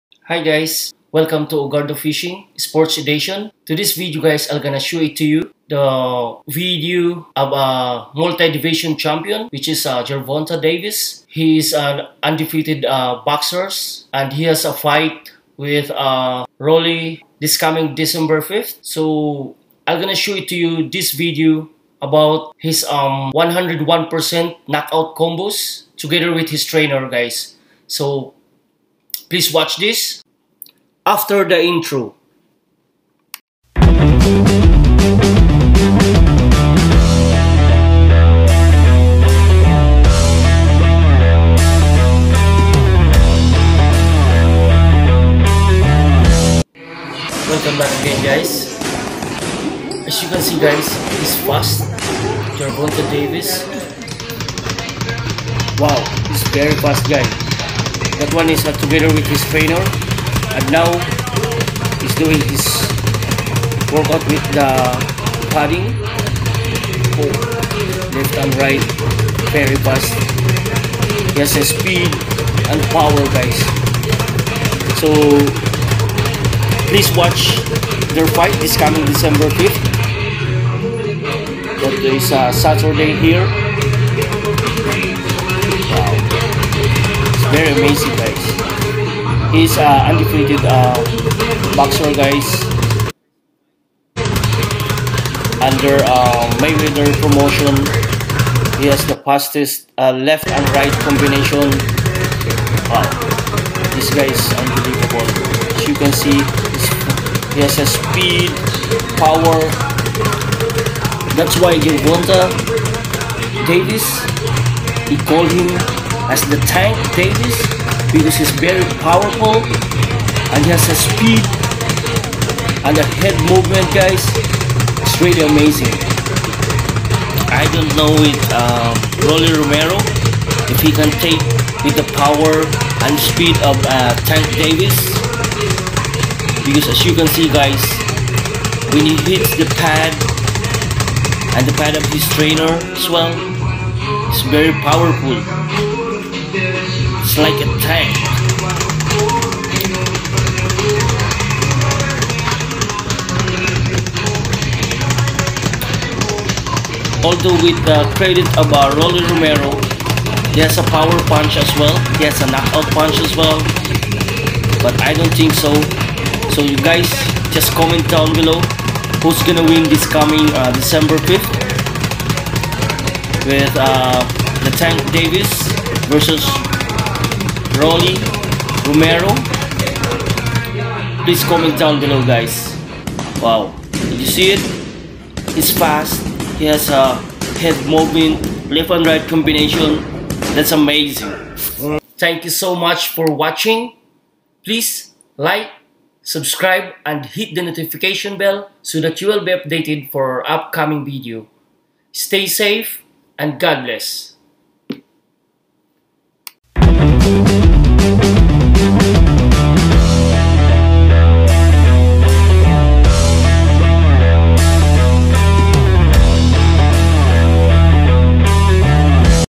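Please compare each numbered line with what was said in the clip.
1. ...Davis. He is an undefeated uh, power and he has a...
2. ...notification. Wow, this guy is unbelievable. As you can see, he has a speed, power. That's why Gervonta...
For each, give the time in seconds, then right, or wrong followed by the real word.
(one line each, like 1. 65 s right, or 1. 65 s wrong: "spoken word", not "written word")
1. 10 s wrong: "boxer", not "power"
2. 101 s wrong: "combination", not "notification".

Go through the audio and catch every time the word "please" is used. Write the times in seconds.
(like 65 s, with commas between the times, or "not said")
29 s, 76 s, 181 s, 194 s.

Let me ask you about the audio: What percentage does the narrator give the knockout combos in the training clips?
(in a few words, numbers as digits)
101%.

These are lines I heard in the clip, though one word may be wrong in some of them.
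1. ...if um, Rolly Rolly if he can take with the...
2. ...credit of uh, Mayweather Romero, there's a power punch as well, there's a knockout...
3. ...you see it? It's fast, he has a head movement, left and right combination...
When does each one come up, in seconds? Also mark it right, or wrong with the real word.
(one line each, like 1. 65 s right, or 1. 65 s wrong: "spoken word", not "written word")
1. 128 s wrong: "Romero", not "Rolly"
2. 158 s wrong: "Rolly", not "Mayweather"
3. 184 s right.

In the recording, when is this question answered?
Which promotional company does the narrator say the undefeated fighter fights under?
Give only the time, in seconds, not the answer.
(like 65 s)
96 s.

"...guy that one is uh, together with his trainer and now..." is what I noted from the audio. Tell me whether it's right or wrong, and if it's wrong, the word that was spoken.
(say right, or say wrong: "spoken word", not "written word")
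right.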